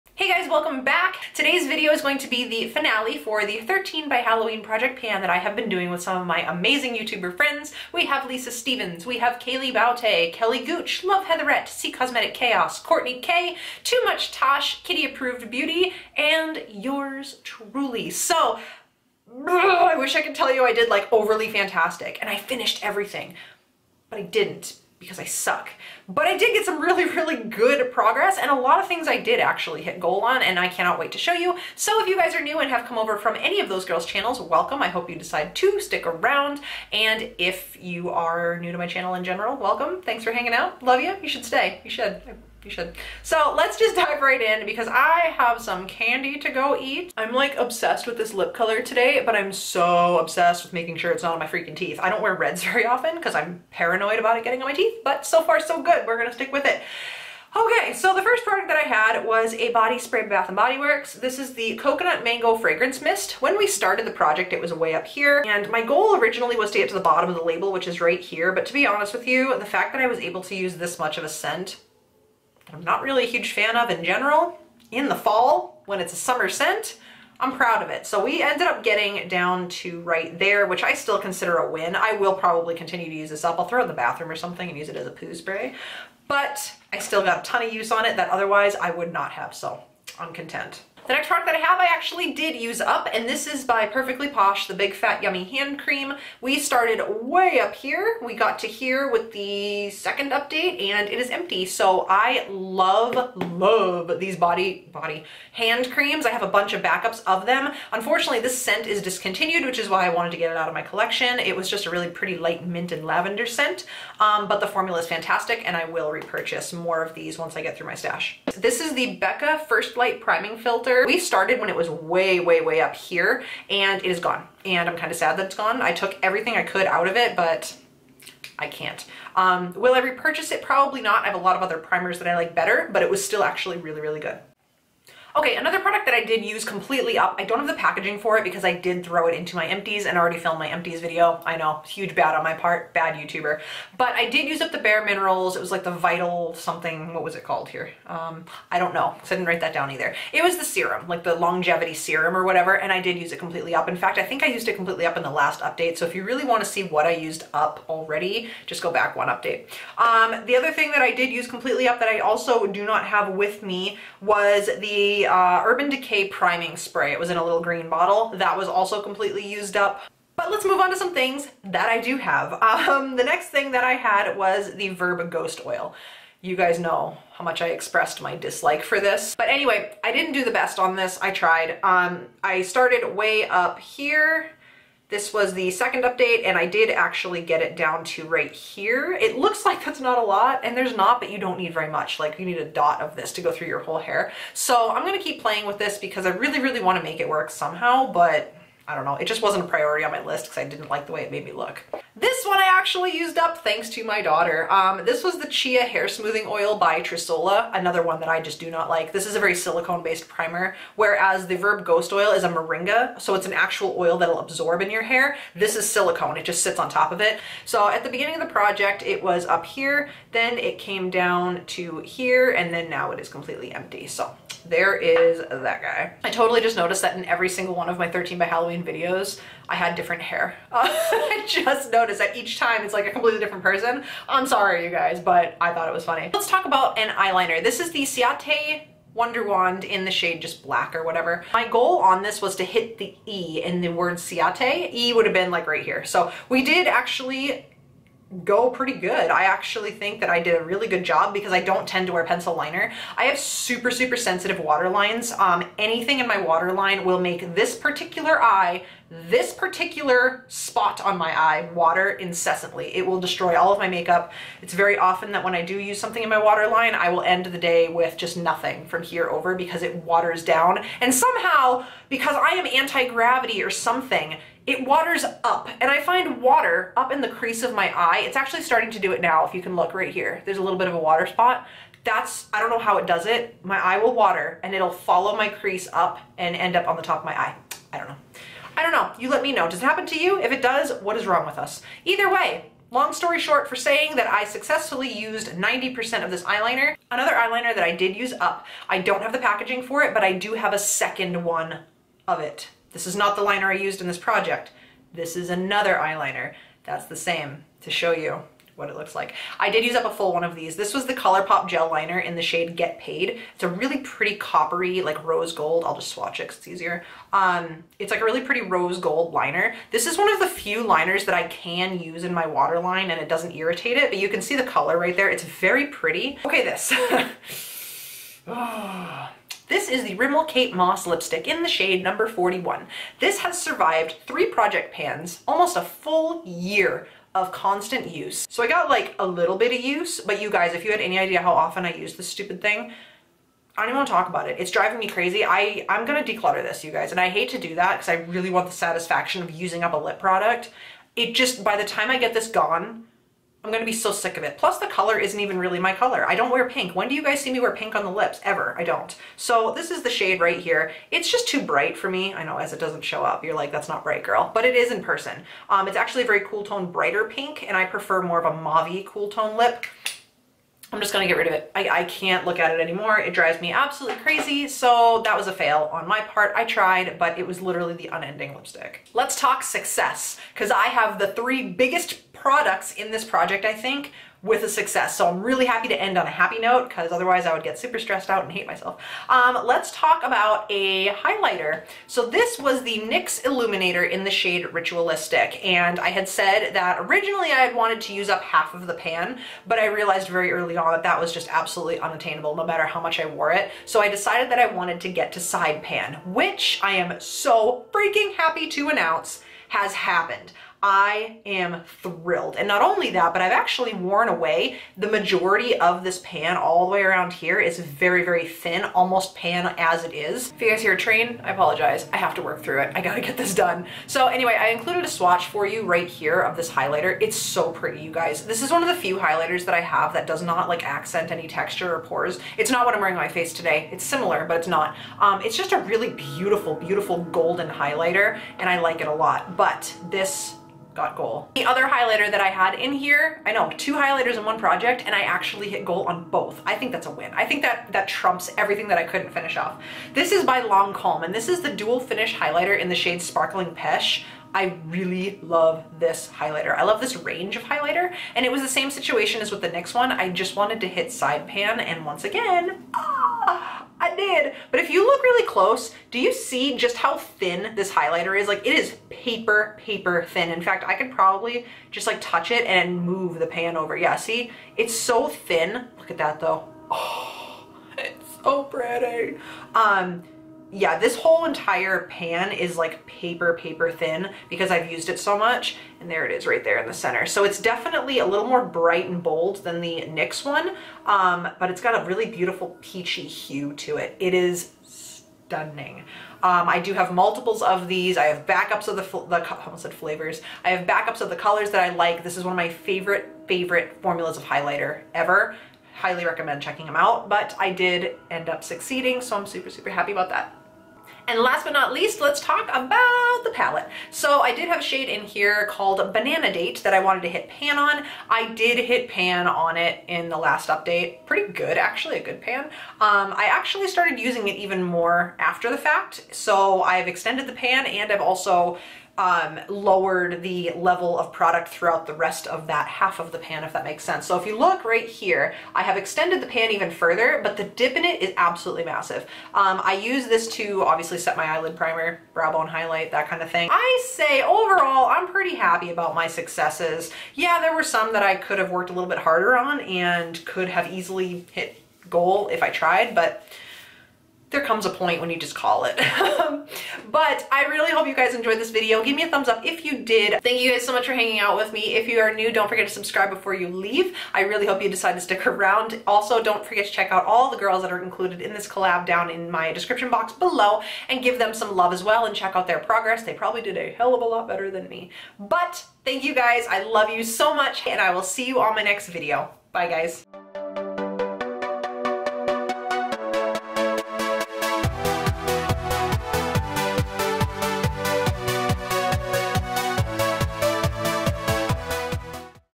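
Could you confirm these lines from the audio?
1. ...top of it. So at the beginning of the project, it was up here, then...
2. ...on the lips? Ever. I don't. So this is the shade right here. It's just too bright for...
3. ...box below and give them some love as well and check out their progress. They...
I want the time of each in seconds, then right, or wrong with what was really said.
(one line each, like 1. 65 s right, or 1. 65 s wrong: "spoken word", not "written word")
1. 216 s right
2. 357 s right
3. 570 s right.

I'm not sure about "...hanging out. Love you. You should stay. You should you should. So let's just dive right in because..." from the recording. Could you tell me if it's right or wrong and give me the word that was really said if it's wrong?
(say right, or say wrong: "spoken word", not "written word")
right.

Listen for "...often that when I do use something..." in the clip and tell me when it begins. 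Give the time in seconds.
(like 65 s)
264 s.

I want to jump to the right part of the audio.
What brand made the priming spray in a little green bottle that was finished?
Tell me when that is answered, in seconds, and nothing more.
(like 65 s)
165 s.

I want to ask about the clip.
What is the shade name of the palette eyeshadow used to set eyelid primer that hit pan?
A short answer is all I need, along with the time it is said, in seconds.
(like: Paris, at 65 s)
Banana Date, at 516 s.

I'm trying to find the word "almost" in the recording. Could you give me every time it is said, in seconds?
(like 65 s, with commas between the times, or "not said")
335 s, 418 s, 499 s.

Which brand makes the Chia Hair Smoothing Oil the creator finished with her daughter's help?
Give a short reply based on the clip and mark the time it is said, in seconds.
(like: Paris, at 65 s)
Trisola, at 207 s.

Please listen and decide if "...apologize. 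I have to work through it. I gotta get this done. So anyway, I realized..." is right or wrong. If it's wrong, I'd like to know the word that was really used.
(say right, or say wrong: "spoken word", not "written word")
wrong: "included", not "realized".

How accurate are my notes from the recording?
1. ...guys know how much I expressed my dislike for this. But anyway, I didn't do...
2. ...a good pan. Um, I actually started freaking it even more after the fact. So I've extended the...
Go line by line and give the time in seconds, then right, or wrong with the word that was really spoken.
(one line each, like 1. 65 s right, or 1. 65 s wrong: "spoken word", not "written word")
1. 176 s right
2. 522 s wrong: "using", not "freaking".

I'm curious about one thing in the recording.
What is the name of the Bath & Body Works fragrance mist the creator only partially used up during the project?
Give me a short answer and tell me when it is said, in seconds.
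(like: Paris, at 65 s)
Coconut Mango, at 61 s.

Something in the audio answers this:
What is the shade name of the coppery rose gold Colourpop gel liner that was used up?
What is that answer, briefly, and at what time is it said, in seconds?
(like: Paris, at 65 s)
Get Paid, at 312 s.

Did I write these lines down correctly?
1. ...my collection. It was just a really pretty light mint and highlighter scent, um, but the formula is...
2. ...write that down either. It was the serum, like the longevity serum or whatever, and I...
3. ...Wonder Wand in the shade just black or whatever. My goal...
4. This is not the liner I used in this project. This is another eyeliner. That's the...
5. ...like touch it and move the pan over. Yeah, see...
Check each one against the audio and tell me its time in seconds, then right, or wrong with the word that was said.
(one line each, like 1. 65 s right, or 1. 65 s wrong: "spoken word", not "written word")
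1. 110 s wrong: "lavender", not "highlighter"
2. 149 s right
3. 239 s right
4. 302 s right
5. 472 s right.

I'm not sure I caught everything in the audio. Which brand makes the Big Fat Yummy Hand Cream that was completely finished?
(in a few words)
Perfectly Posh.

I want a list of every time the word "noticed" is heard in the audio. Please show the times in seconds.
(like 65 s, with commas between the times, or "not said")
226 s, 231 s.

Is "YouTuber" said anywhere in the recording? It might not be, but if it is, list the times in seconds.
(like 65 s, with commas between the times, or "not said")
6 s, 143 s.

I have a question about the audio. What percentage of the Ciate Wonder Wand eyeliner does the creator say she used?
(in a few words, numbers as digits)
90%.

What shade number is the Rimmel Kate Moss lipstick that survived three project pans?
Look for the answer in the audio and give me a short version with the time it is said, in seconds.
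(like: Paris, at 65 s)
41, at 332 s.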